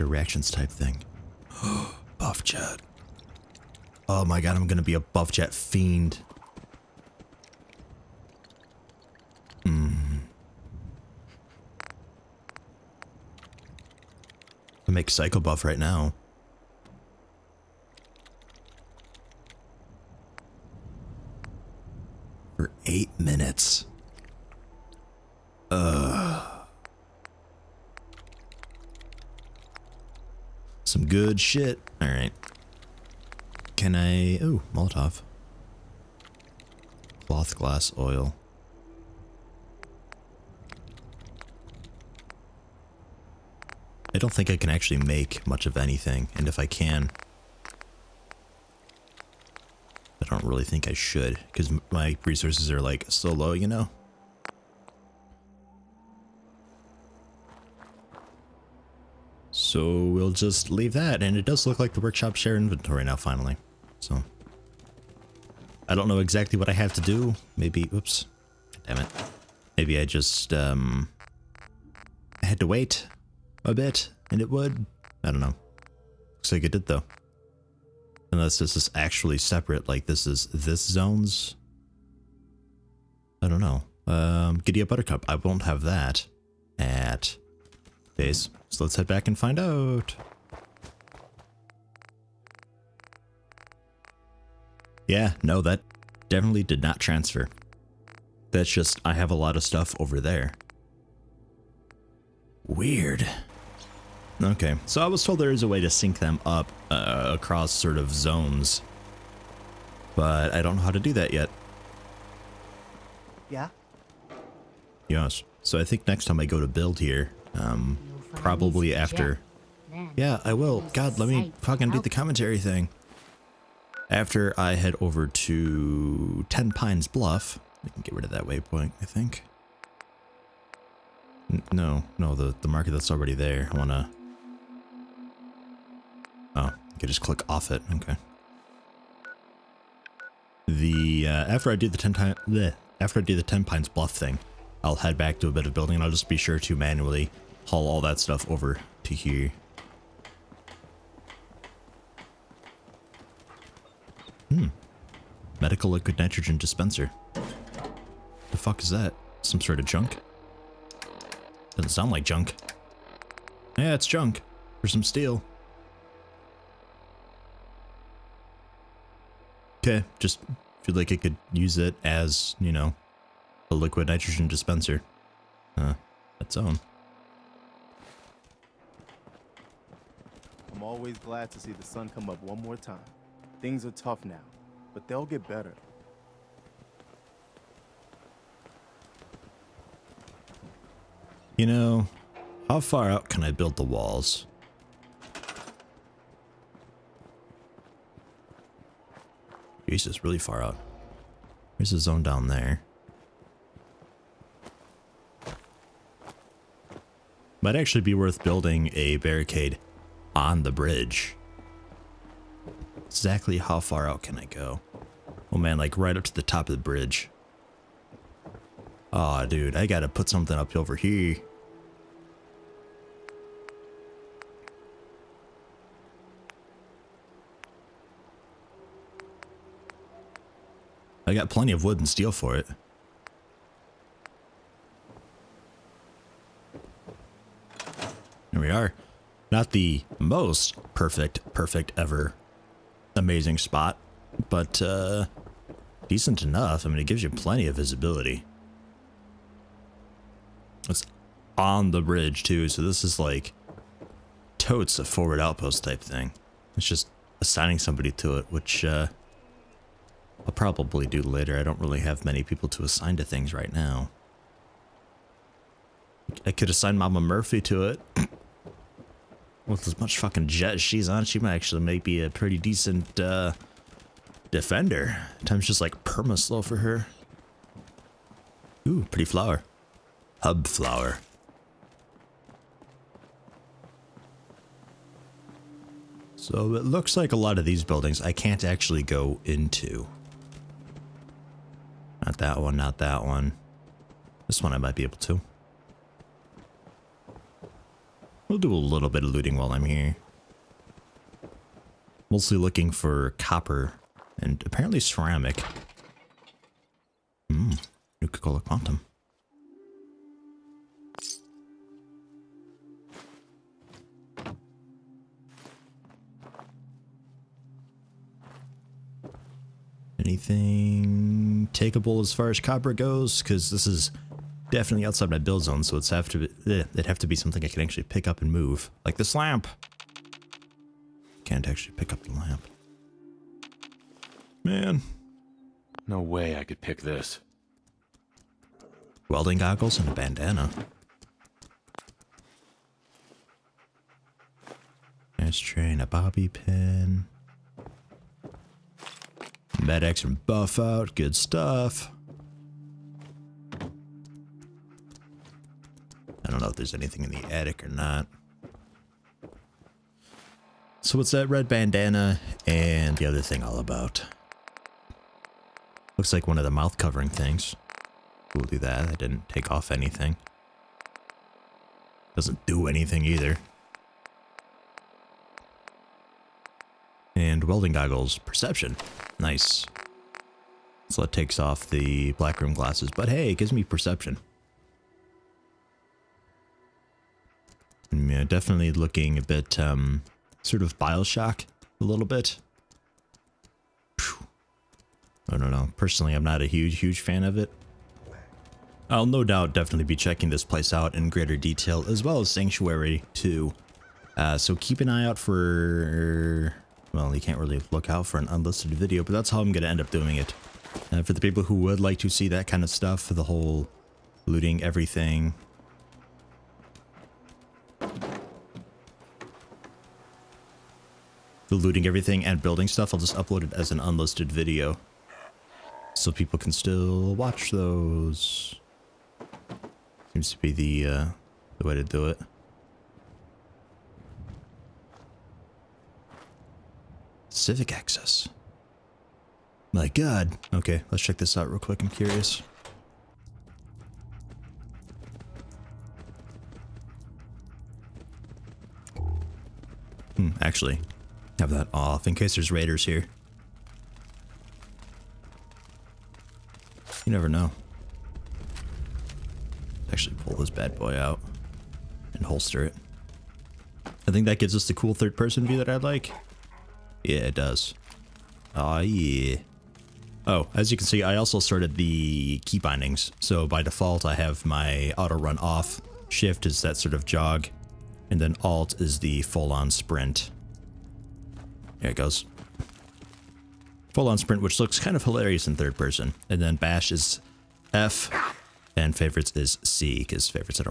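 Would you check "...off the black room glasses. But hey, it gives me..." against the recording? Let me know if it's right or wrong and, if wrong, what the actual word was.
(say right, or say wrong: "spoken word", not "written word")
right.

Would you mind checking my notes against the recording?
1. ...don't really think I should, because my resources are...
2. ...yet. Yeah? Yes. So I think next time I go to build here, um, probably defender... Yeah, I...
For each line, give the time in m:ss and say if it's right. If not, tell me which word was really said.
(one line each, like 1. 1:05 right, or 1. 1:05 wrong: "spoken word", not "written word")
1. 0:50 right
2. 1:51 wrong: "after", not "defender".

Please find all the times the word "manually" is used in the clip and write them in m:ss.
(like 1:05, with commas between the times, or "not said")
2:26.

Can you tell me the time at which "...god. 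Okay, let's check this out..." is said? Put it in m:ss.
7:20.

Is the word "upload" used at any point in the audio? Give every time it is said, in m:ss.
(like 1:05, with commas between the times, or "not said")
7:03.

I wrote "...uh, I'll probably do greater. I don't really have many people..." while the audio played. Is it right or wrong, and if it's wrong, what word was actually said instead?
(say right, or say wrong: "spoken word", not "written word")
wrong: "later", not "greater".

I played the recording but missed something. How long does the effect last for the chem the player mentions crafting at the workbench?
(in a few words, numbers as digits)
8 minutes.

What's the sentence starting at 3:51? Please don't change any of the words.
I got plenty of wood and steel for it.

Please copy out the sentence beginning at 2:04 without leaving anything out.
After I head over to Ten Pines Bluff, we can get rid of that waypoint, I think.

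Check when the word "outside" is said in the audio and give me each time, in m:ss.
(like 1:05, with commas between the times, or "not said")
5:25.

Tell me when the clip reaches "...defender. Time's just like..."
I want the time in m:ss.
4:34.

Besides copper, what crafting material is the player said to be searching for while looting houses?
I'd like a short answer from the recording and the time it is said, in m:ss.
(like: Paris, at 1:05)
ceramic, at 5:04.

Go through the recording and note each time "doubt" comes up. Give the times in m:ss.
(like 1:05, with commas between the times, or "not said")
6:39.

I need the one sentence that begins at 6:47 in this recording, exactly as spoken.
Well, you can't really look out for an unlisted video, but that's how I'm going to end up doing it.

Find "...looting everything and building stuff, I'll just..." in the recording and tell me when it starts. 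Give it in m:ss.
7:01.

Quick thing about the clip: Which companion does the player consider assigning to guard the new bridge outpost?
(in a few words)
Mama Murphy.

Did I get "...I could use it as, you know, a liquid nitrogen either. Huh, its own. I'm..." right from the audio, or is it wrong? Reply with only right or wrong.
wrong.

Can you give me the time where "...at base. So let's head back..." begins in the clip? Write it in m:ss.
1:26.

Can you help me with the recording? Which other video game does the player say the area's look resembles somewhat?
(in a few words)
Bioshock.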